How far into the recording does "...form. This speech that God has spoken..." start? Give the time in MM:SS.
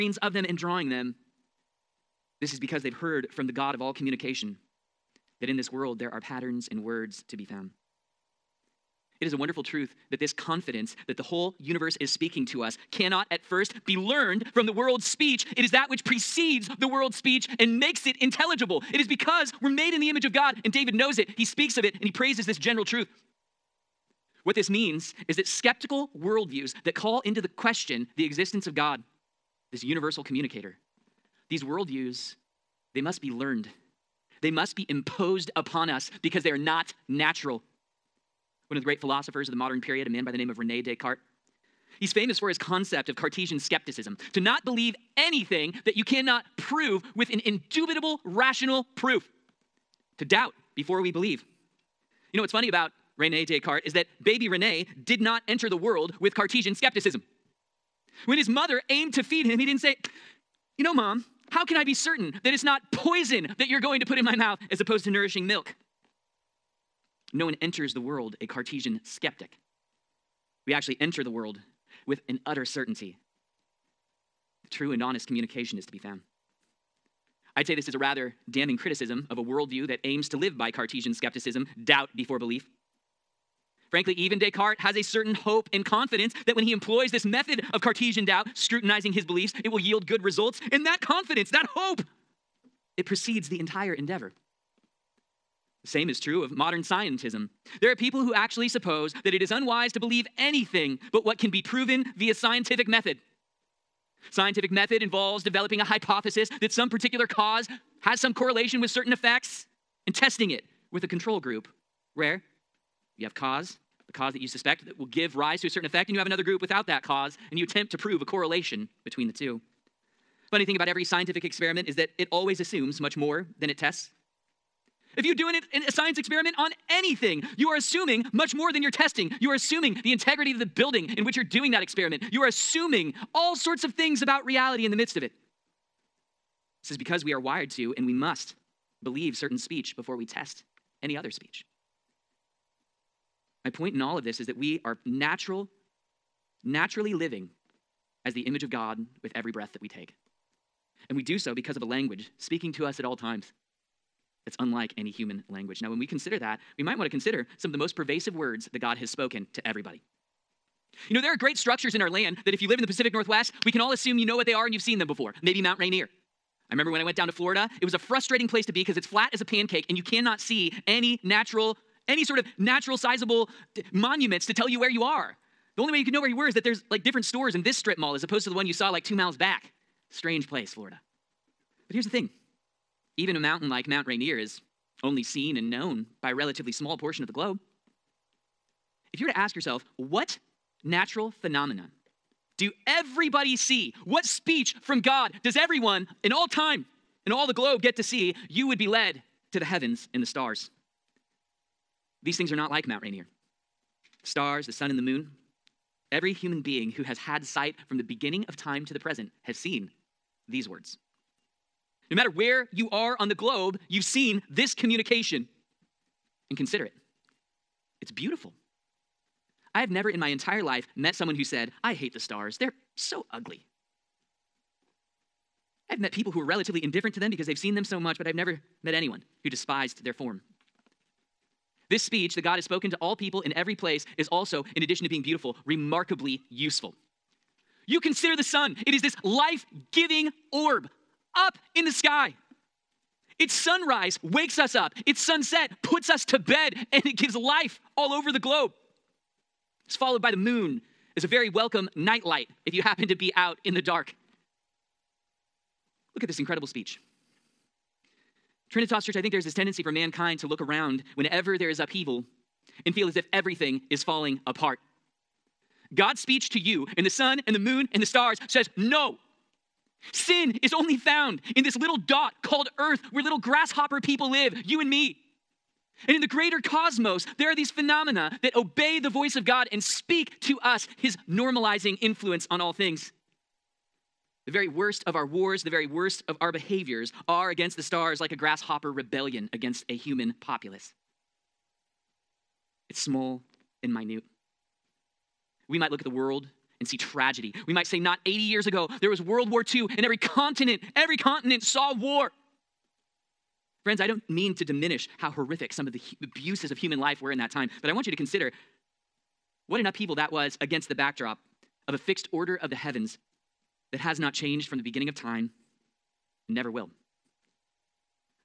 03:50.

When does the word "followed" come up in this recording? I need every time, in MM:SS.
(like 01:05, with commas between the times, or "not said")
04:09.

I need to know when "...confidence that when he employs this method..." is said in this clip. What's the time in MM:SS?
01:25.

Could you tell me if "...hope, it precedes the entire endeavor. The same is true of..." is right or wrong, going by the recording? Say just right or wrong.
right.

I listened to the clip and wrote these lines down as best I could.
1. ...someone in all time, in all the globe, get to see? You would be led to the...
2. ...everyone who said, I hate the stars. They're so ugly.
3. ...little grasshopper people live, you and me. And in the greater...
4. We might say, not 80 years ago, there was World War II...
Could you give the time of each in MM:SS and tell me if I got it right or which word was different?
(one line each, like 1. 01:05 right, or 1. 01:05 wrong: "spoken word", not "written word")
1. 03:15 wrong: "everyone", not "someone"
2. 03:41 wrong: "someone", not "everyone"
3. 04:33 right
4. 04:57 right.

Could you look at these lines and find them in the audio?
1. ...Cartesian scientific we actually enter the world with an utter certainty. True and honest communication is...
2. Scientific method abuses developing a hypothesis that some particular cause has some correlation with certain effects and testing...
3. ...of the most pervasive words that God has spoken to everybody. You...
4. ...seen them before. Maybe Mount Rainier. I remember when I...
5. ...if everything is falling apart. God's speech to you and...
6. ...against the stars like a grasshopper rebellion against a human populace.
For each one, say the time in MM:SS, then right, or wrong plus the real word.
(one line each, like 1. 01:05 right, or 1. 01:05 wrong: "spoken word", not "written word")
1. 01:08 wrong: "skeptic", not "scientific"
2. 01:44 wrong: "involves", not "abuses"
3. 02:37 right
4. 02:44 right
5. 04:23 right
6. 04:47 right.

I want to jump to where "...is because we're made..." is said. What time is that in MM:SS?
00:18.